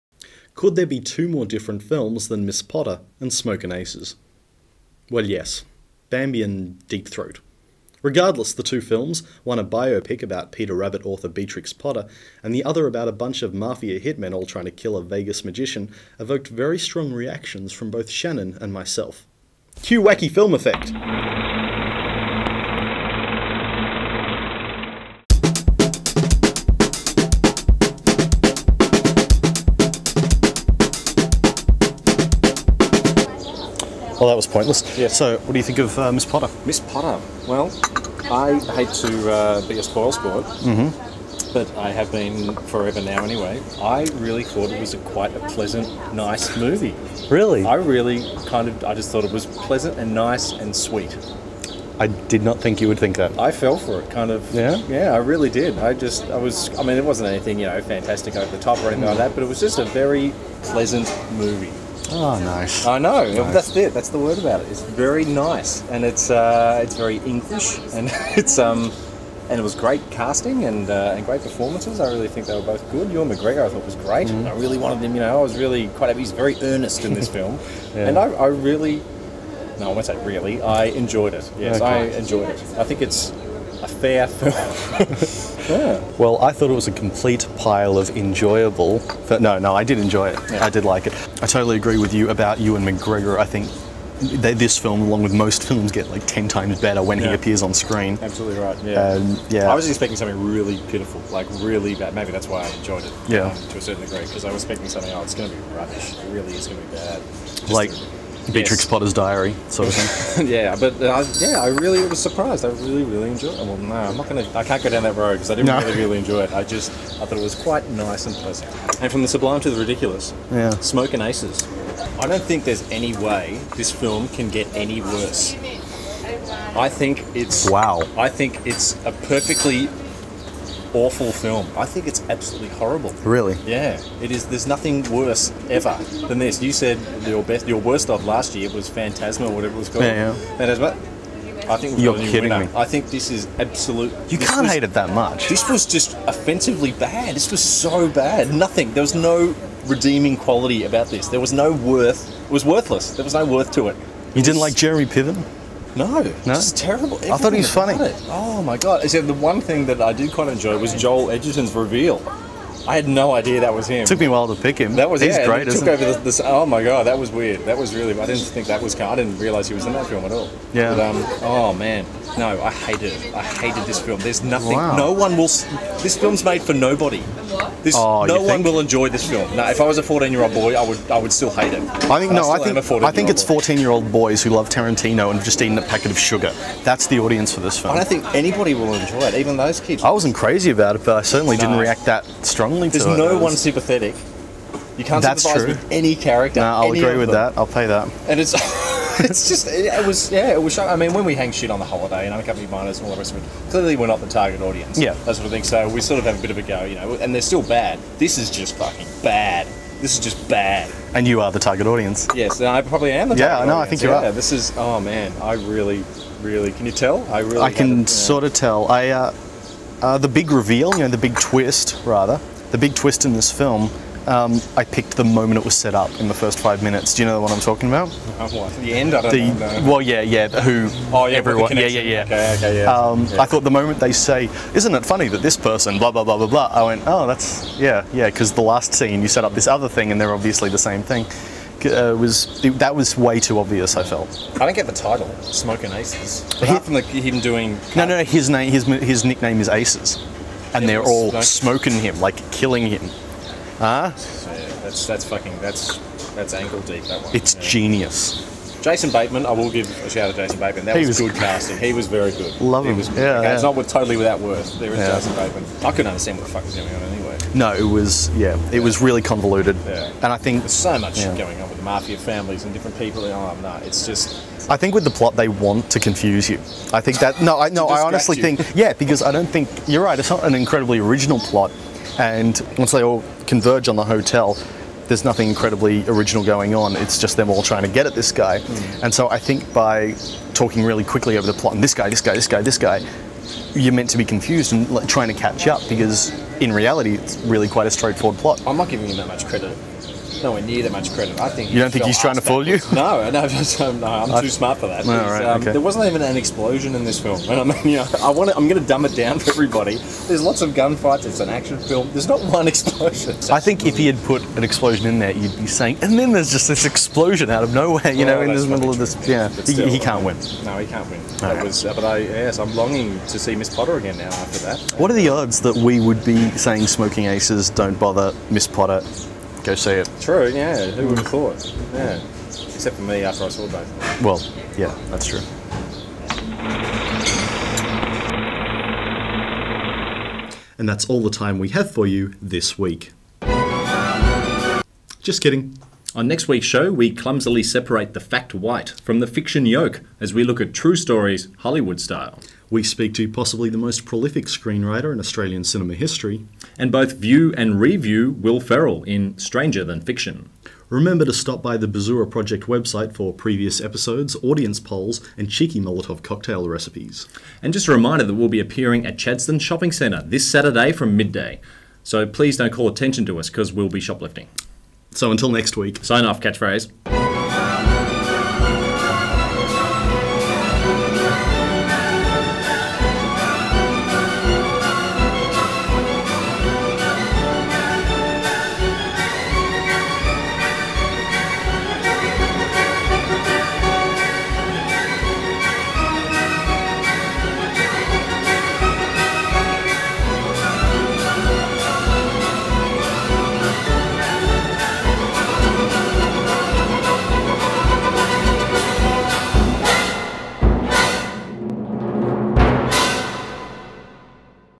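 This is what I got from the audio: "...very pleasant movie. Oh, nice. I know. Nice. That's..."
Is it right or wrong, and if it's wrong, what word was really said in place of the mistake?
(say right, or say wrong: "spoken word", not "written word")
right.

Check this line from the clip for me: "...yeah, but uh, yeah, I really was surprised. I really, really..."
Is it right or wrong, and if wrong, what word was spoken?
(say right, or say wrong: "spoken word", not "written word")
right.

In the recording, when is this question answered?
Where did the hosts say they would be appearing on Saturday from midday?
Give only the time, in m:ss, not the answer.
6:09.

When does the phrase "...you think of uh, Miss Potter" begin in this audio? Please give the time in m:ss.
0:35.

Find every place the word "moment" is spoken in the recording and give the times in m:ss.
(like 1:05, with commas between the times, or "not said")
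3:45, 3:53.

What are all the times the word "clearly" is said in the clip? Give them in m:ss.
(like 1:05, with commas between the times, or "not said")
3:23.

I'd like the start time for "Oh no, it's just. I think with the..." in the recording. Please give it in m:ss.
4:33.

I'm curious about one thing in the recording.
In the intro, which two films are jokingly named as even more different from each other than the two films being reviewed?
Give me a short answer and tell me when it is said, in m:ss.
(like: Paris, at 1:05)
Bambi and Deep Throat, at 0:06.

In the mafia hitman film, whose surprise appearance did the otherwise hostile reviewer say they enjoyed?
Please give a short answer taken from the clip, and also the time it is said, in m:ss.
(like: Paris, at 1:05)
Joel Edgerton, at 2:40.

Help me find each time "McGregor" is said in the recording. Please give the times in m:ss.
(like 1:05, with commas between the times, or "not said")
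1:13, 1:32.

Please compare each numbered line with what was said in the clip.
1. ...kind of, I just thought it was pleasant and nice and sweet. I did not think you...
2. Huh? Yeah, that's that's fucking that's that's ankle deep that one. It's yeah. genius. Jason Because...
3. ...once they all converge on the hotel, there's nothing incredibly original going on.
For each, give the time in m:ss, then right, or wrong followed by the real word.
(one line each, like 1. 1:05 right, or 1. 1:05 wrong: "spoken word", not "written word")
1. 0:48 right
2. 4:13 wrong: "Bateman", not "Because"
3. 4:42 right.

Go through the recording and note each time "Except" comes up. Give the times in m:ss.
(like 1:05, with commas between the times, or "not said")
2:39, 5:32.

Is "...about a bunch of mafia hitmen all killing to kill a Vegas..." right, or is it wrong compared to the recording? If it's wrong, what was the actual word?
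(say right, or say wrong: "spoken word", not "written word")
wrong: "trying", not "killing".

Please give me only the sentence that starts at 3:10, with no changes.
I wasn't crazy about it, but I certainly no.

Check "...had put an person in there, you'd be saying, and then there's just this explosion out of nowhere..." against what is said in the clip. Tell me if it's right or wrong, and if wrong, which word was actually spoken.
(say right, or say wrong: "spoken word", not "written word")
wrong: "explosion", not "person".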